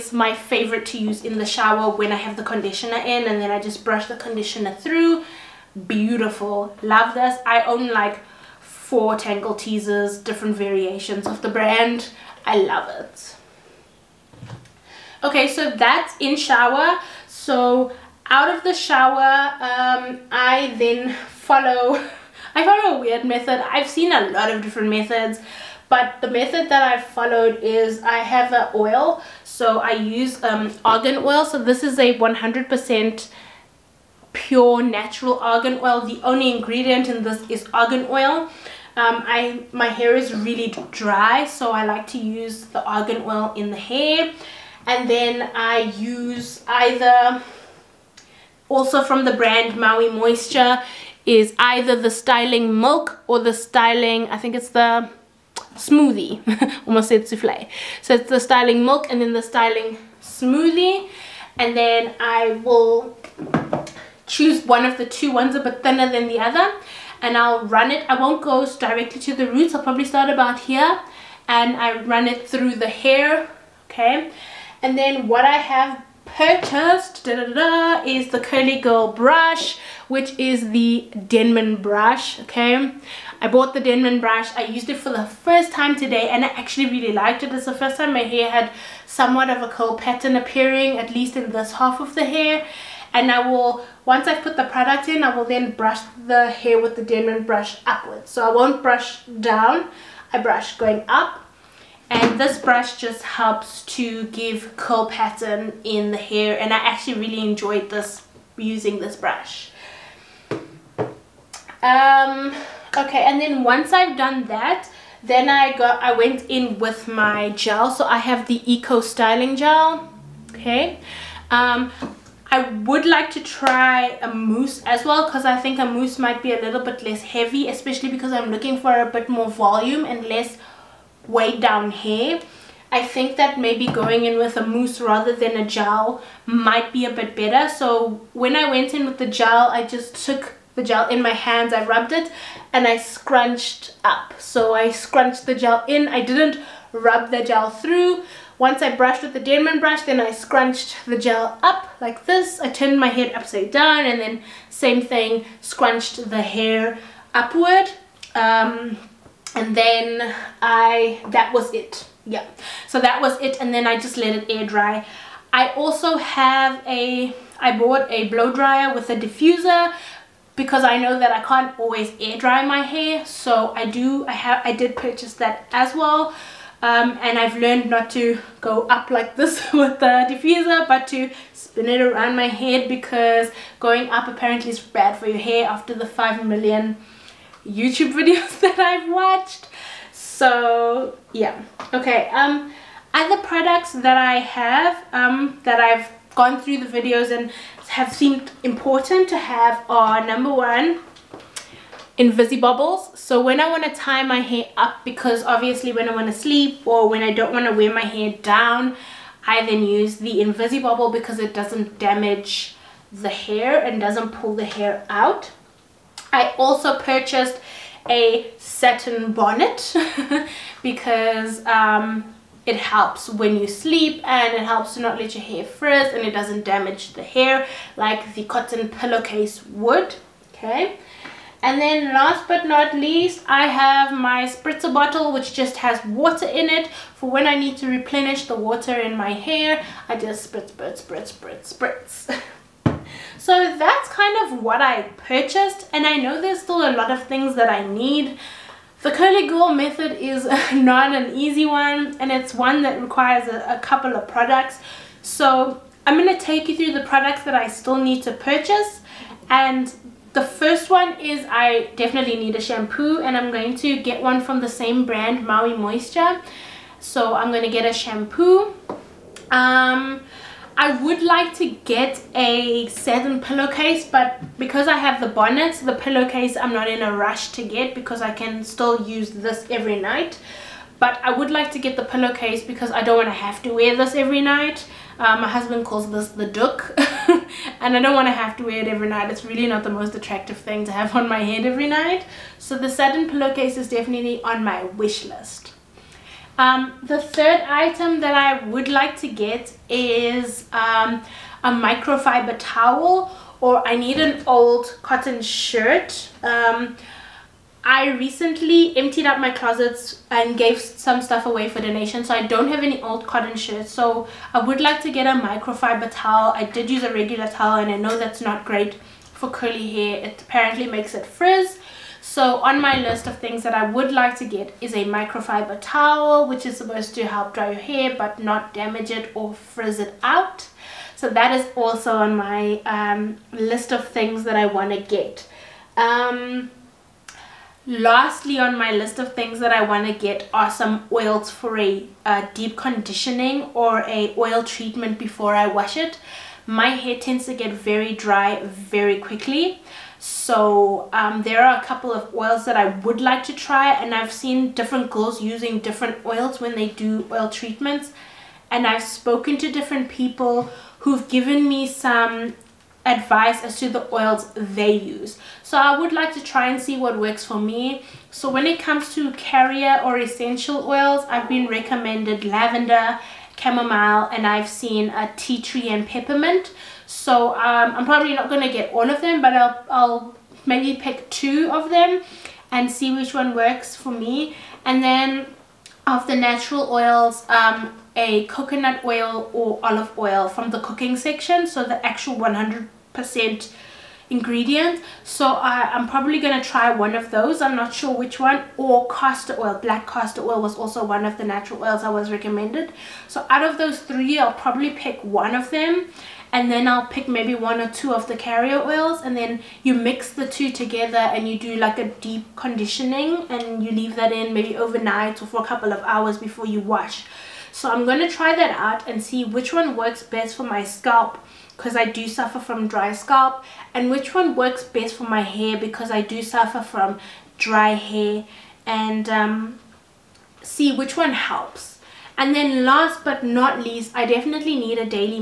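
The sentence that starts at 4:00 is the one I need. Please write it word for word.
I just spritz, spritz, spritz, spritz, spritz.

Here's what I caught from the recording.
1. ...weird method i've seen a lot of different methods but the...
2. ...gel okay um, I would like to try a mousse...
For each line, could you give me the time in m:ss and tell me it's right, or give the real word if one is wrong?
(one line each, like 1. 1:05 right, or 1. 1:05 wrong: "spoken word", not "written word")
1. 0:23 right
2. 1:59 right.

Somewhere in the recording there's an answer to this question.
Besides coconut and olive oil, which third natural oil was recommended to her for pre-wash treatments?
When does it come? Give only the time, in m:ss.
6:39.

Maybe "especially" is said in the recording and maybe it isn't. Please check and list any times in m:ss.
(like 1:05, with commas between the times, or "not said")
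2:07.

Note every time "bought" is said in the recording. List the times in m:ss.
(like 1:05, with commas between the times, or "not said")
1:23, 2:47.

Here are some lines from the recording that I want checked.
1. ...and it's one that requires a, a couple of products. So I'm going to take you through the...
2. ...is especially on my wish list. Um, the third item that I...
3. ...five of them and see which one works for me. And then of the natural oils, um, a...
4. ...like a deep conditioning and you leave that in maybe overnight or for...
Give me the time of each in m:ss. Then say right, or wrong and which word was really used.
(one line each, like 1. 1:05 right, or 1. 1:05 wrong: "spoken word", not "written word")
1. 4:12 right
2. 4:53 wrong: "definitely", not "especially"
3. 6:21 wrong: "two", not "five"
4. 6:51 right.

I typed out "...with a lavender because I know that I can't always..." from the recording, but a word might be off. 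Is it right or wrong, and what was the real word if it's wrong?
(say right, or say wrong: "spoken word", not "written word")
wrong: "diffuser", not "lavender".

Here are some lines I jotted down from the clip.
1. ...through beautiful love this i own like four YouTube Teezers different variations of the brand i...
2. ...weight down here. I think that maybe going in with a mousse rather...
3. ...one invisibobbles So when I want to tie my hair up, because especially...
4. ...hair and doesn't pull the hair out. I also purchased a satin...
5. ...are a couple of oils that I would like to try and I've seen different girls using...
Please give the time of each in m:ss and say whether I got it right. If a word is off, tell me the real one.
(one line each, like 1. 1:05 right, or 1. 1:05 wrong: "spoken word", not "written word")
1. 0:04 wrong: "Tangle", not "YouTube"
2. 2:11 right
3. 3:20 wrong: "obviously", not "especially"
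4. 3:33 right
5. 5:51 right.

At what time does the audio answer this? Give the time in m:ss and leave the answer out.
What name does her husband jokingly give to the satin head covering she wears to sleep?
4:46.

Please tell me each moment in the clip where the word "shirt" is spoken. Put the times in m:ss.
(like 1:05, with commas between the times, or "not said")
5:05, 5:13.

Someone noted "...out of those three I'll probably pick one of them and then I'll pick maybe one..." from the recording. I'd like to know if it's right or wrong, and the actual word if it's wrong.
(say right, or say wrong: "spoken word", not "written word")
right.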